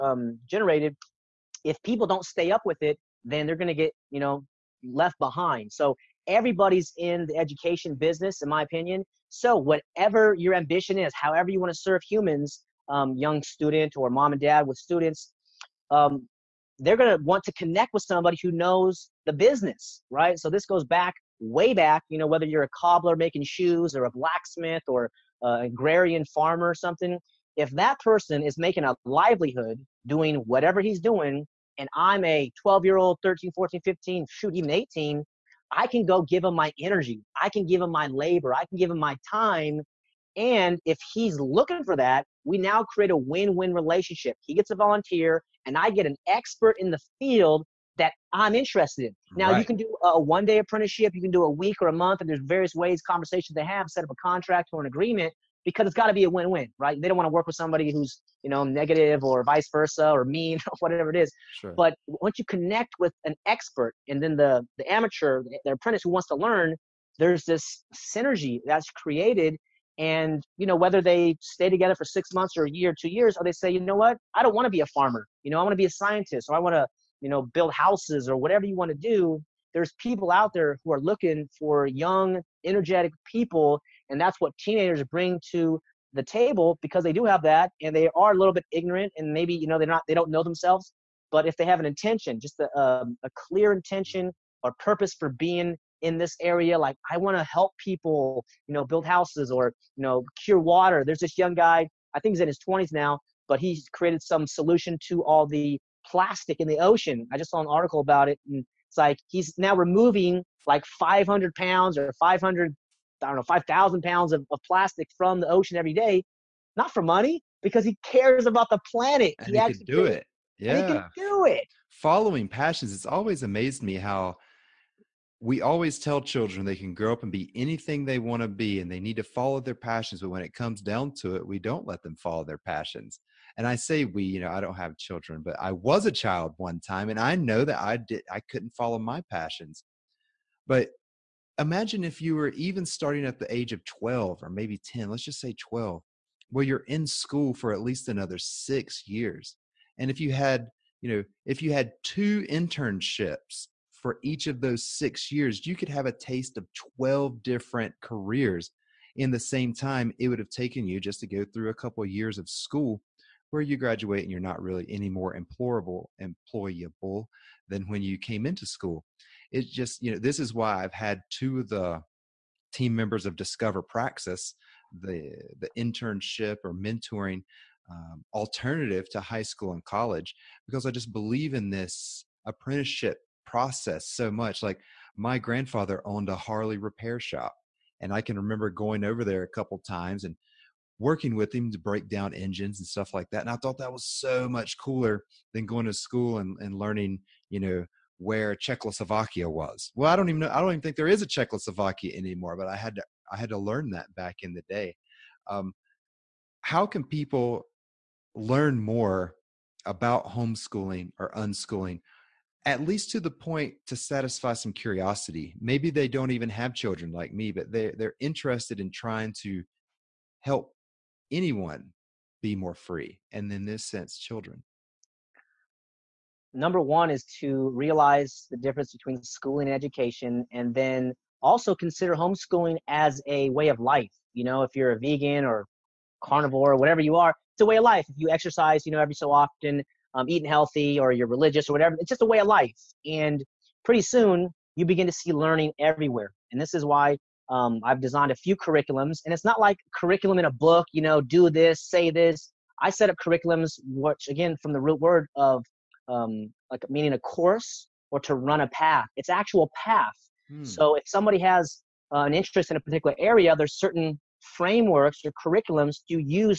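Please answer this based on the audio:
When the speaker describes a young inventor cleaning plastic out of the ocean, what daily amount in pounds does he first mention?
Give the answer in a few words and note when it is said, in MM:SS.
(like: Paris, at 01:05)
500 pounds, at 01:50.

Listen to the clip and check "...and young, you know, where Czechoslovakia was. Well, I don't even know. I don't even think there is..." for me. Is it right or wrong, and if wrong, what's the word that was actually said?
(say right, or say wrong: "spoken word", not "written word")
wrong: "learning", not "young".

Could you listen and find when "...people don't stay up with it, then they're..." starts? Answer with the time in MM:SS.
00:01.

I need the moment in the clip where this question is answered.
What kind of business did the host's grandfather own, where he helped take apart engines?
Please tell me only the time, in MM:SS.
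03:06.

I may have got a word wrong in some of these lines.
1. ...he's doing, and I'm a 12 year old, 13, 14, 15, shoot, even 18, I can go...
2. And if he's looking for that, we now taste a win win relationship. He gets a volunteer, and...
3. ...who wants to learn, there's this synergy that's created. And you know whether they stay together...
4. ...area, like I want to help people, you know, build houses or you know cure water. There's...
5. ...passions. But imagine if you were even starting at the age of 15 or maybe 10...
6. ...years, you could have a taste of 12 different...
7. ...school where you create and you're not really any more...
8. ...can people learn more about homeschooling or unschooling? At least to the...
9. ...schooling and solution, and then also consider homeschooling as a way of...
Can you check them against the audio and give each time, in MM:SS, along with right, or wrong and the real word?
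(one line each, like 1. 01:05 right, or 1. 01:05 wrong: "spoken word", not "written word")
1. 00:30 right
2. 00:40 wrong: "create", not "taste"
3. 01:06 right
4. 01:36 right
5. 02:19 wrong: "12", not "15"
6. 02:35 right
7. 02:42 wrong: "graduate", not "create"
8. 03:26 right
9. 03:49 wrong: "education", not "solution".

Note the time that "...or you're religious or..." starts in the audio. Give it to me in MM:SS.
04:00.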